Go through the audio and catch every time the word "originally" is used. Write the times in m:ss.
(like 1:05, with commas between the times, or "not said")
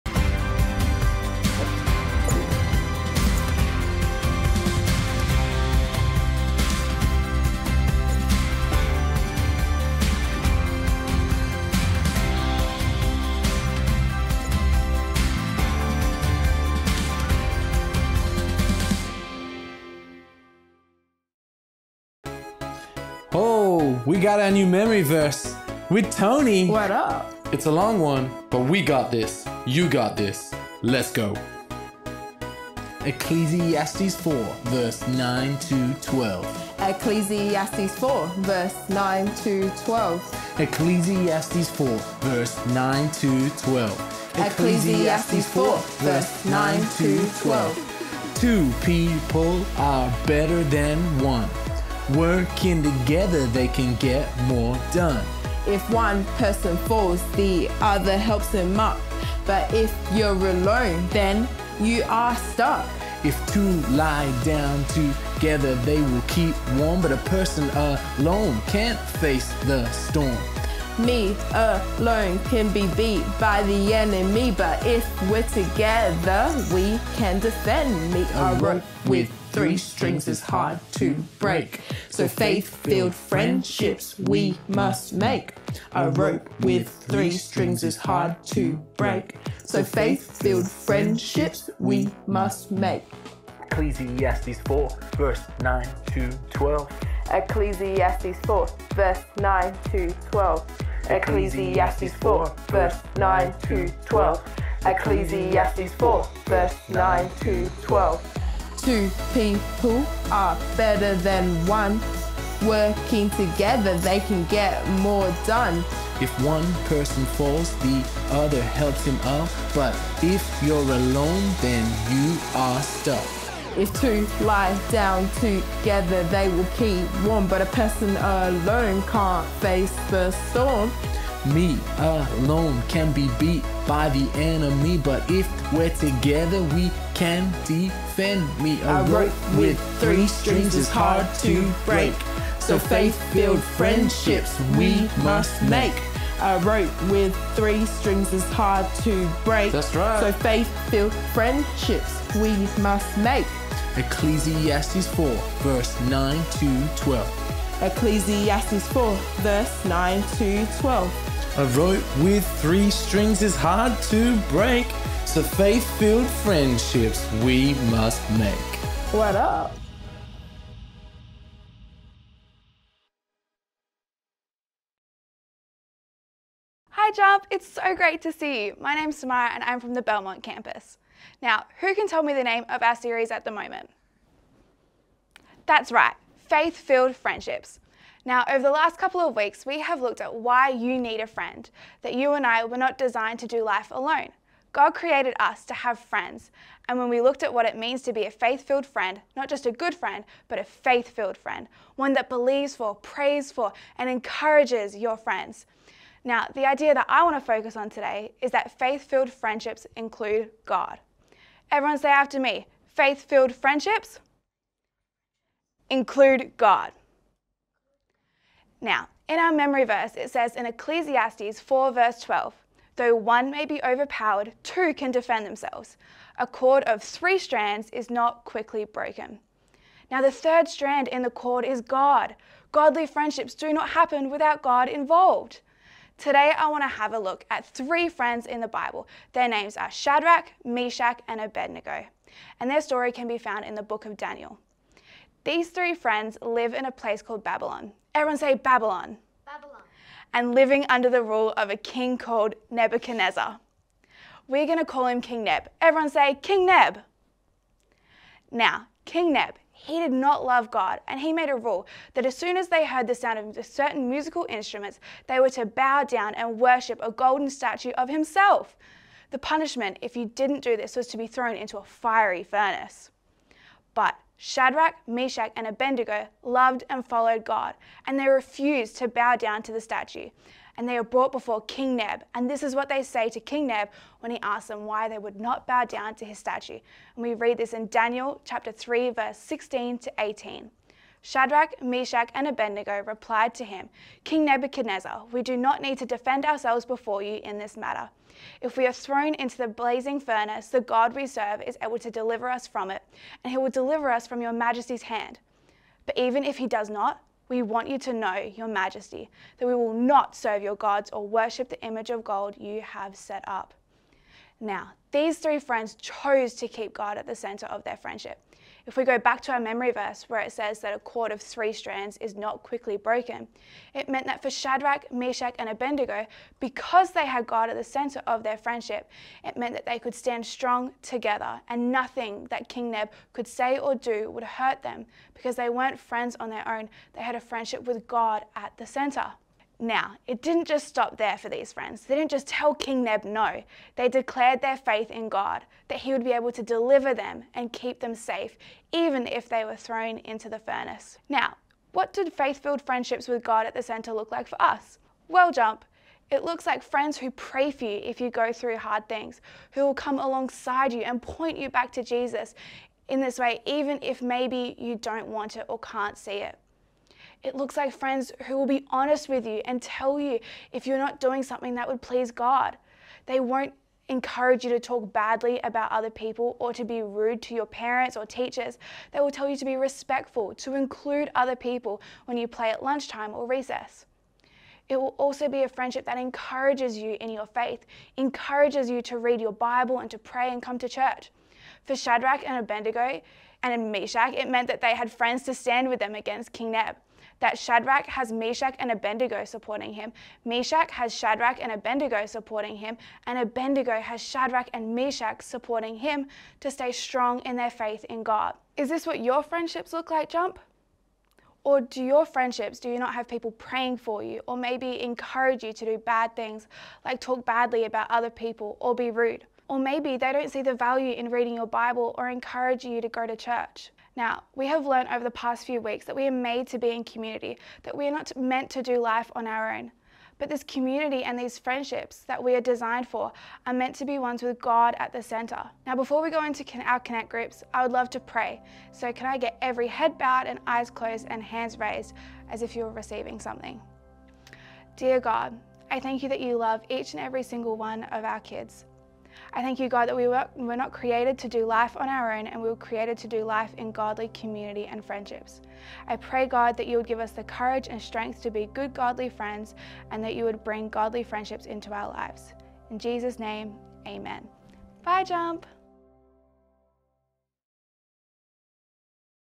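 not said.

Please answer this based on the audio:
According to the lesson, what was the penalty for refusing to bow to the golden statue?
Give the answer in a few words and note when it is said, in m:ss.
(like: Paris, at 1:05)
Thrown into a fiery furnace, at 4:31.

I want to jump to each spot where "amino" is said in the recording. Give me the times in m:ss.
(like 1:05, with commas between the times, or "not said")
not said.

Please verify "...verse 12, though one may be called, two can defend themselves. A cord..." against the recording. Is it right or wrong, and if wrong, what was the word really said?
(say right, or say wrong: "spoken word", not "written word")
wrong: "overpowered", not "called".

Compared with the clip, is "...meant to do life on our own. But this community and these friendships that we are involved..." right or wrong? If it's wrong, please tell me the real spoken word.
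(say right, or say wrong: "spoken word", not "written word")
wrong: "designed", not "involved".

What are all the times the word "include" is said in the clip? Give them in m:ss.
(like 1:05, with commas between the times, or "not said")
3:29, 3:35, 6:20.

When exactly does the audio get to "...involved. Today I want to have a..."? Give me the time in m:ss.
3:54.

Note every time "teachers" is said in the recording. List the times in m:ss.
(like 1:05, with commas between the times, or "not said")
6:18.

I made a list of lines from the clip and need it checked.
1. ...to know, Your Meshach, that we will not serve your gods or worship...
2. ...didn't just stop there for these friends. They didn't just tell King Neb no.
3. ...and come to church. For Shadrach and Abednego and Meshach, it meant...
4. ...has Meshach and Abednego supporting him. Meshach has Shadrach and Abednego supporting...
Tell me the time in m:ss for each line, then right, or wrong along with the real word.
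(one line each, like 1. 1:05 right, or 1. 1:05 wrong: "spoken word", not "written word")
1. 5:07 wrong: "Majesty", not "Meshach"
2. 5:40 right
3. 6:30 right
4. 6:38 right.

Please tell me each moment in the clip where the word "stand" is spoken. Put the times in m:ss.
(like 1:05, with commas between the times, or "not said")
5:30, 6:35.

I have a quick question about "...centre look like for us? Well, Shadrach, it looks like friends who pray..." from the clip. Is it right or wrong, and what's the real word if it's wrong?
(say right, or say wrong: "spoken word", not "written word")
wrong: "Jump", not "Shadrach".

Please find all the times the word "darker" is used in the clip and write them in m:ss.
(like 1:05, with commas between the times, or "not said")
not said.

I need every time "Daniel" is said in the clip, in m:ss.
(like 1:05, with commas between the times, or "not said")
4:04, 4:47.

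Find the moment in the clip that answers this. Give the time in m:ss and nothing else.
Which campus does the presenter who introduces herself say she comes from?
3:00.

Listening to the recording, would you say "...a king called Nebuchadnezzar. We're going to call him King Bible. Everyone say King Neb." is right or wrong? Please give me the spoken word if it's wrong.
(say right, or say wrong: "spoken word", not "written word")
wrong: "Neb", not "Bible".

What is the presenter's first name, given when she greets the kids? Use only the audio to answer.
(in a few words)
Samara.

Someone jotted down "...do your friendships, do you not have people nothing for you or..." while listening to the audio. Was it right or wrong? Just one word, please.
wrong.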